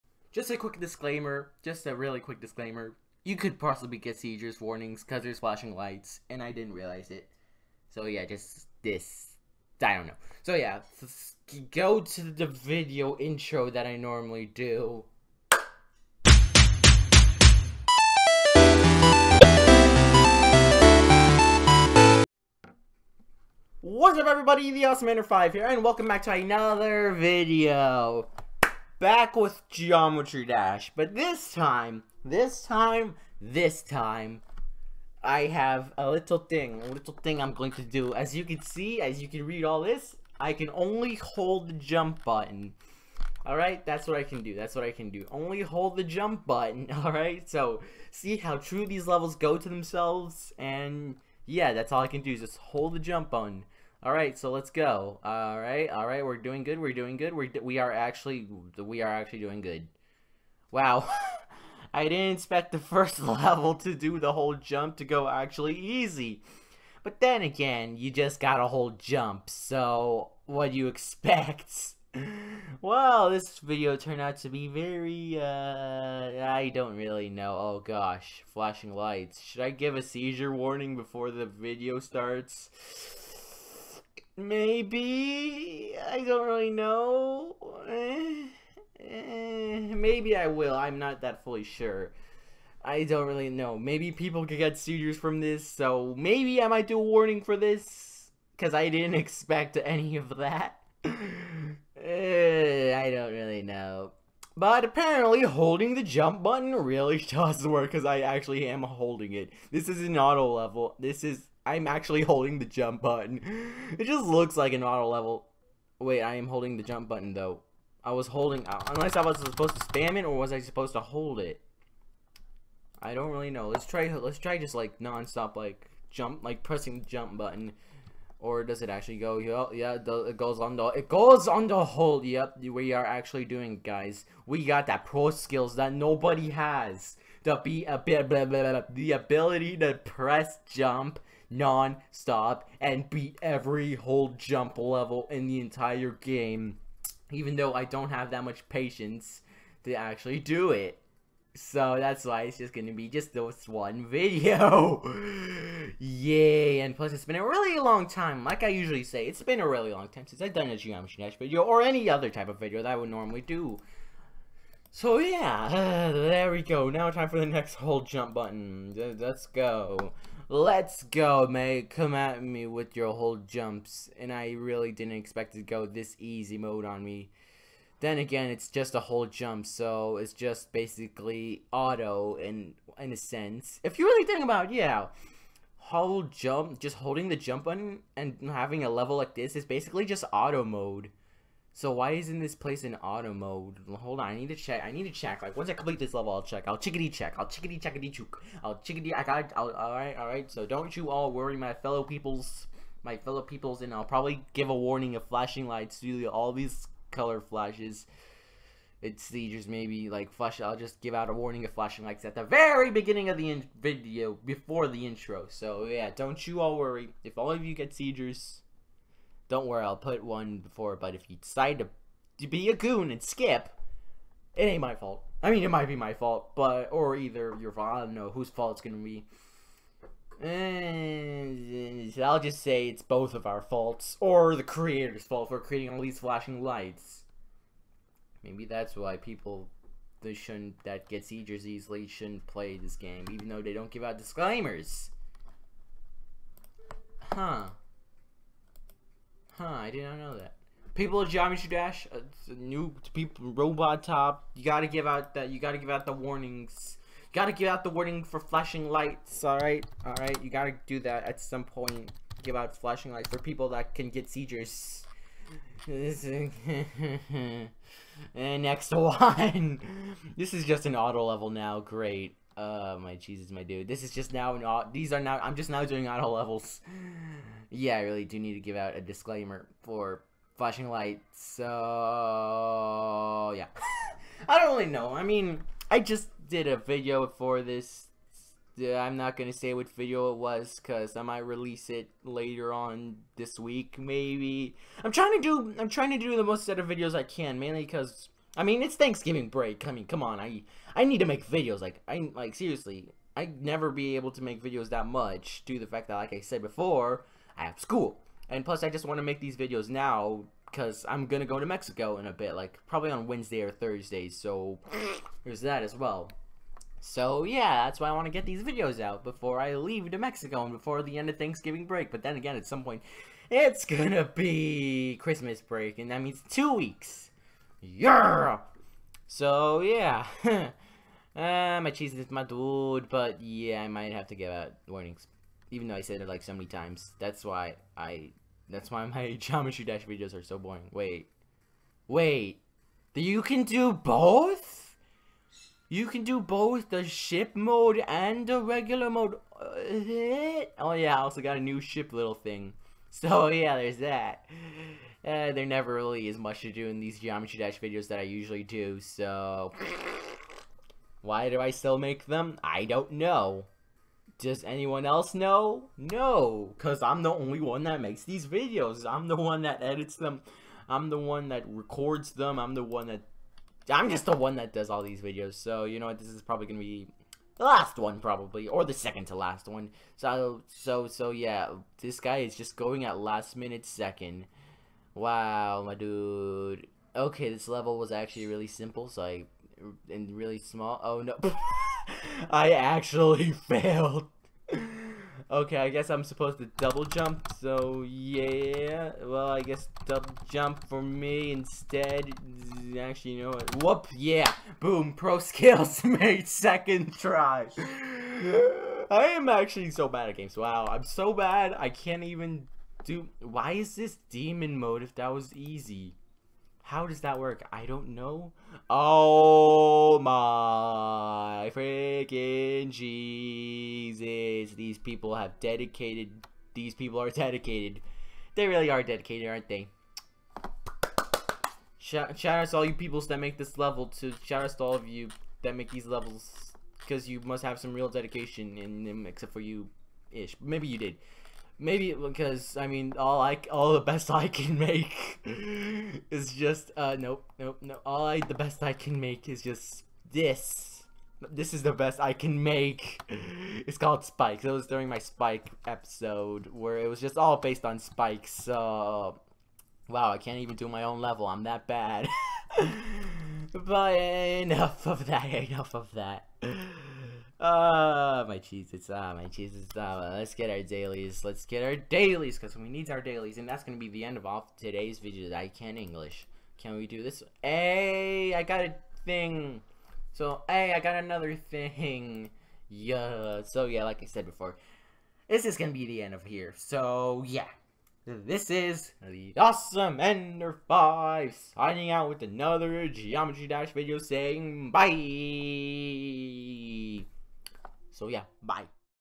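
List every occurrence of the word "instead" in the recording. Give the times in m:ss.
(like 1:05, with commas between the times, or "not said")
6:41.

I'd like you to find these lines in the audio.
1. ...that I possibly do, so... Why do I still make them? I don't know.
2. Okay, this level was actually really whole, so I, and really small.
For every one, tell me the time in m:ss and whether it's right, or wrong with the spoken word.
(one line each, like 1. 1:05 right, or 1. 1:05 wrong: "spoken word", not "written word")
1. 5:58 wrong: "usually", not "possibly"
2. 6:27 wrong: "simple", not "whole".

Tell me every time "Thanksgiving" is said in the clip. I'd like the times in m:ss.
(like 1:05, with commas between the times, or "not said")
4:58, 5:21.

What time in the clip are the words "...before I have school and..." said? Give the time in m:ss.
5:06.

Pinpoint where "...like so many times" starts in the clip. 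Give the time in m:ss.
5:36.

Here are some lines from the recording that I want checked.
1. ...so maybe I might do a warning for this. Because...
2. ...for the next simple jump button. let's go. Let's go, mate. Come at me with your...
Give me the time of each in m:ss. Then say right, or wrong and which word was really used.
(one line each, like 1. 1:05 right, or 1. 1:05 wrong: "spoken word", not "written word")
1. 1:35 right
2. 2:47 wrong: "whole", not "simple".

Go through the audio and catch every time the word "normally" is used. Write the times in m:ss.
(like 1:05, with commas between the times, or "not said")
0:13, 2:43.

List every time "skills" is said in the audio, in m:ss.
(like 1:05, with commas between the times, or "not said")
2:15, 6:45.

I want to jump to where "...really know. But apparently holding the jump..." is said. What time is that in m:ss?
1:43.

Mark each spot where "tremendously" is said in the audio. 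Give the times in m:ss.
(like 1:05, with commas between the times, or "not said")
not said.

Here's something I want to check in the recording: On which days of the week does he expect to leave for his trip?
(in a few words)
Wednesday or Thursday.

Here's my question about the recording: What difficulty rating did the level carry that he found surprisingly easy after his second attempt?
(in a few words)
Demon mode.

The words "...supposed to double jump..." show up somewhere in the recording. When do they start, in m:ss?
6:36.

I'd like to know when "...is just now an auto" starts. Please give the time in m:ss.
4:34.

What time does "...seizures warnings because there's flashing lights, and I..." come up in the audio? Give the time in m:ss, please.
0:04.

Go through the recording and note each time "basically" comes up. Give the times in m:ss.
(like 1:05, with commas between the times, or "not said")
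3:00, 3:09.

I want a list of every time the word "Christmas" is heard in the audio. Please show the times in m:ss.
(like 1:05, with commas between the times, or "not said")
5:25.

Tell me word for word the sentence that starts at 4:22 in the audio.
Give out flashing lights for people that can get seizures.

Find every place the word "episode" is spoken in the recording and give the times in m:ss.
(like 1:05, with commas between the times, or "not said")
7:35.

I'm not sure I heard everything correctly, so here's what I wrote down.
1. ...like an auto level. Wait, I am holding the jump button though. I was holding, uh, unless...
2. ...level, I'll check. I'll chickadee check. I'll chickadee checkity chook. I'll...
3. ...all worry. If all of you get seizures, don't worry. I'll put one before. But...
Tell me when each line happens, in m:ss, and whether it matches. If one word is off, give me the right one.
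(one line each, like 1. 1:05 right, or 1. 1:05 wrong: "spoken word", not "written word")
1. 1:54 right
2. 3:16 right
3. 3:36 right.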